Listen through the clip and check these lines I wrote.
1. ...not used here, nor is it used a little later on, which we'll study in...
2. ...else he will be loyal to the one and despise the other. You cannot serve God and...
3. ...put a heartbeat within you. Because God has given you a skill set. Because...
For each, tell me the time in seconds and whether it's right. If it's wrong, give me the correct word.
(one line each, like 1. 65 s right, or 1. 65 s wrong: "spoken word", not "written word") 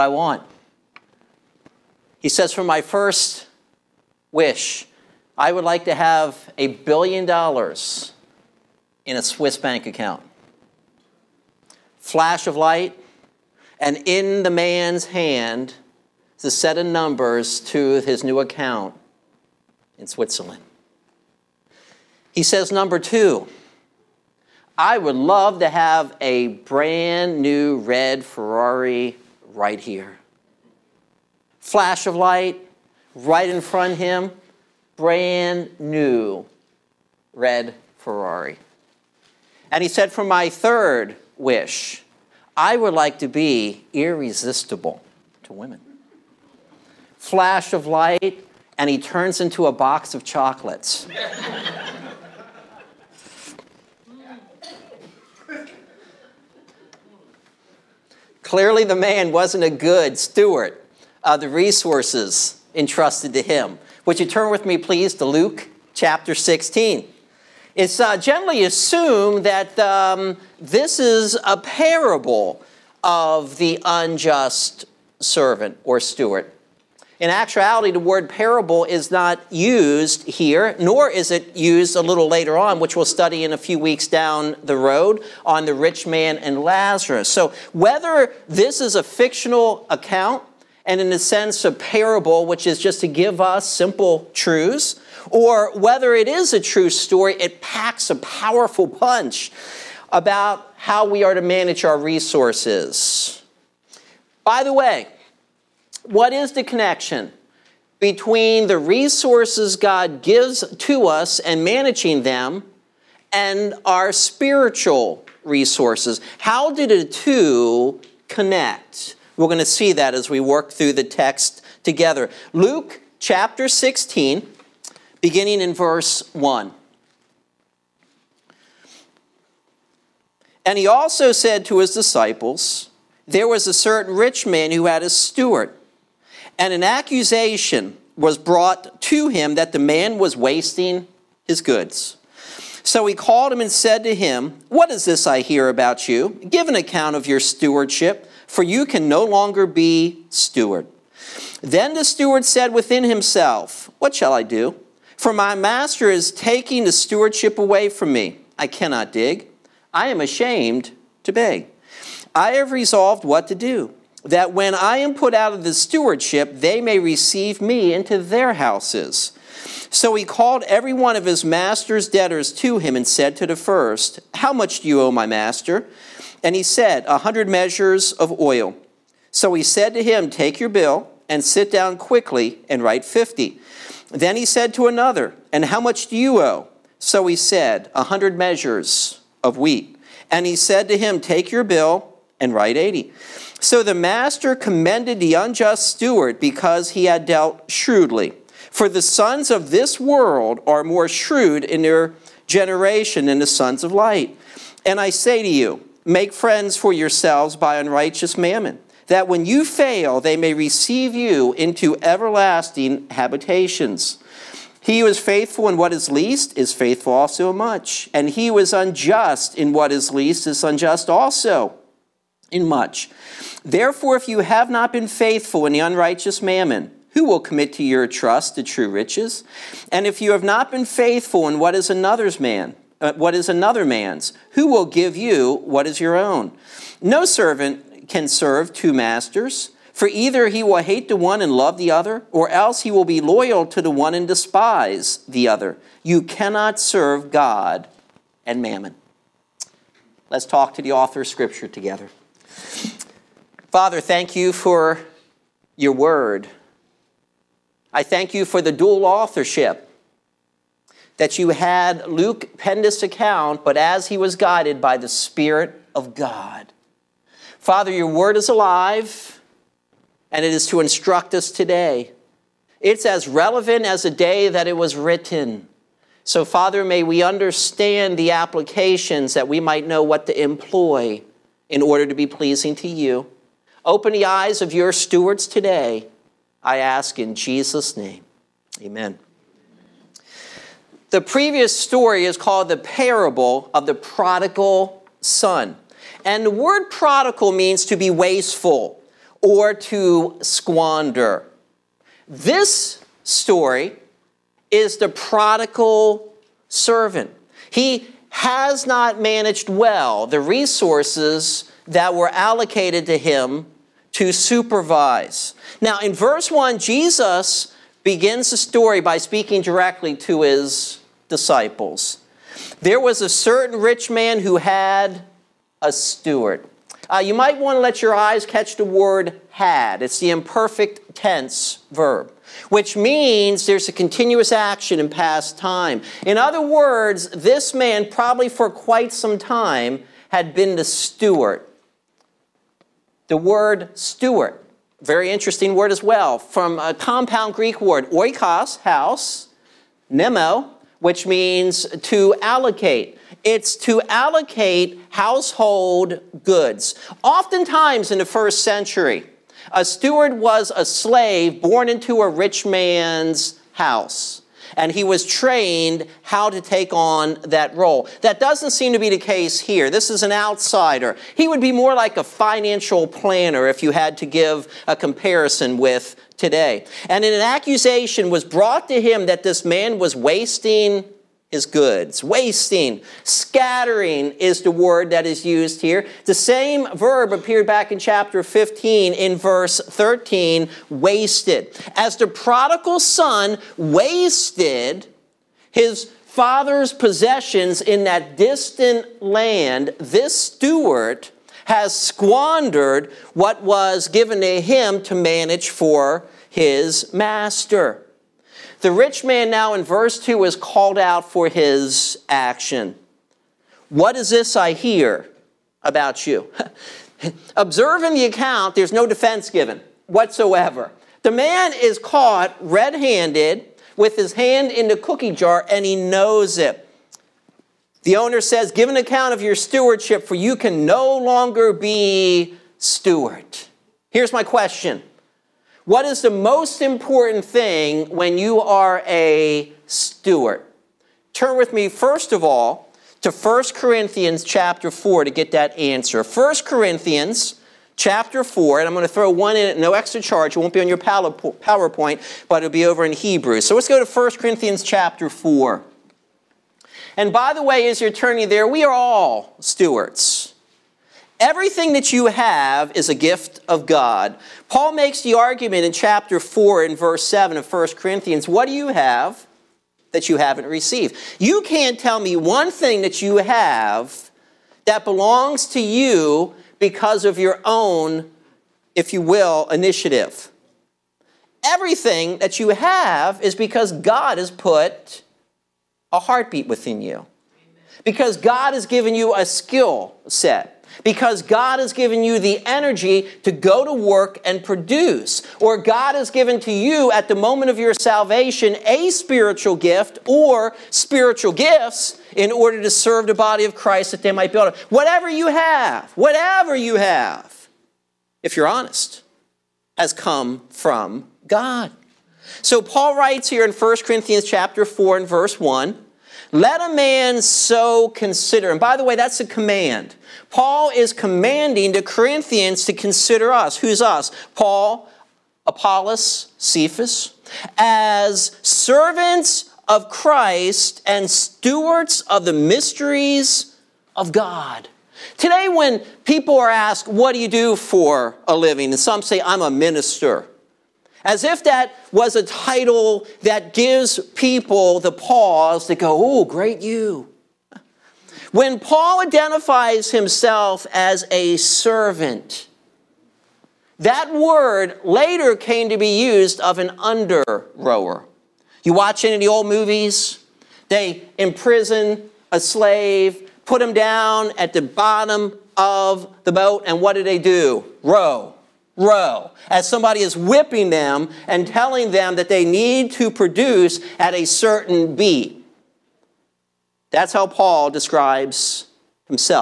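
1. 79 s right
2. 242 s right
3. 484 s right.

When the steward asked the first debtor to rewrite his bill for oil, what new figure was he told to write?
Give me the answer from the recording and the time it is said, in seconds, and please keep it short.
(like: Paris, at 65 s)
50, at 183 s.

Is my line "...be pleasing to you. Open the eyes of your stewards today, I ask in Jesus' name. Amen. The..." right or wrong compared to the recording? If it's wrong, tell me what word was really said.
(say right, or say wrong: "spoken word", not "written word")
right.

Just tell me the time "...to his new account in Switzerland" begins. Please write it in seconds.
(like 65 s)
17 s.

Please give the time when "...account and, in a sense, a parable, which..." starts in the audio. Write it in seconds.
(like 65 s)
89 s.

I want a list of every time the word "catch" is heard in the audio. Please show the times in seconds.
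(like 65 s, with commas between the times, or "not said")
328 s.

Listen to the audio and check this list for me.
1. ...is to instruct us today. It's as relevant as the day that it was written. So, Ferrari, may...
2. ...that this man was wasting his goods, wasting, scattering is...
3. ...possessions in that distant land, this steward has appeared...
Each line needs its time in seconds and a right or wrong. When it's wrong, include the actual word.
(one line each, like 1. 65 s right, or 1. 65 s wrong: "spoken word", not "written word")
1. 270 s wrong: "Father", not "Ferrari"
2. 379 s right
3. 396 s wrong: "squandered", not "appeared".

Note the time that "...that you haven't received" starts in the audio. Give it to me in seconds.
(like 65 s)
470 s.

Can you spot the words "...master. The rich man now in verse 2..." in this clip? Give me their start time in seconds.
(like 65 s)
407 s.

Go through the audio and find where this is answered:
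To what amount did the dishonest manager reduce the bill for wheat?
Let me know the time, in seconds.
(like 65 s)
192 s.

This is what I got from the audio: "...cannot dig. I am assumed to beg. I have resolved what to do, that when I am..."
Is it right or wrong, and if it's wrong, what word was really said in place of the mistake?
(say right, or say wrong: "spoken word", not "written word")
wrong: "ashamed", not "assumed".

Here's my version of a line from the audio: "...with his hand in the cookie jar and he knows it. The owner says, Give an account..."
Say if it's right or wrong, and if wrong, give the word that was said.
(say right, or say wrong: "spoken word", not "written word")
right.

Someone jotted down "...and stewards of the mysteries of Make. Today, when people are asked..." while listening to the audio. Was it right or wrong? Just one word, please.
wrong.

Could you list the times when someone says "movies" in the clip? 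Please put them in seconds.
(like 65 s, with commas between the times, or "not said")
559 s.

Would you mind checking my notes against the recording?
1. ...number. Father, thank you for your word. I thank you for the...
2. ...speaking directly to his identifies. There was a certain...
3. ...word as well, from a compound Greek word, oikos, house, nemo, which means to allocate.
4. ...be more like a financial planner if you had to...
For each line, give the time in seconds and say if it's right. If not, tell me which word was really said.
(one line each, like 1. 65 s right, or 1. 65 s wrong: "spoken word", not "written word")
1. 251 s wrong: "together", not "number"
2. 319 s wrong: "disciples", not "identifies"
3. 345 s right
4. 371 s right.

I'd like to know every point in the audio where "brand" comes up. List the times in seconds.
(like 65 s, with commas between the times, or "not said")
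26 s, 34 s.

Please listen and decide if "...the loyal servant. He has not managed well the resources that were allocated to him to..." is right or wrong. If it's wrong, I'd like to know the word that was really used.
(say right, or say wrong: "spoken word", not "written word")
wrong: "prodigal", not "loyal".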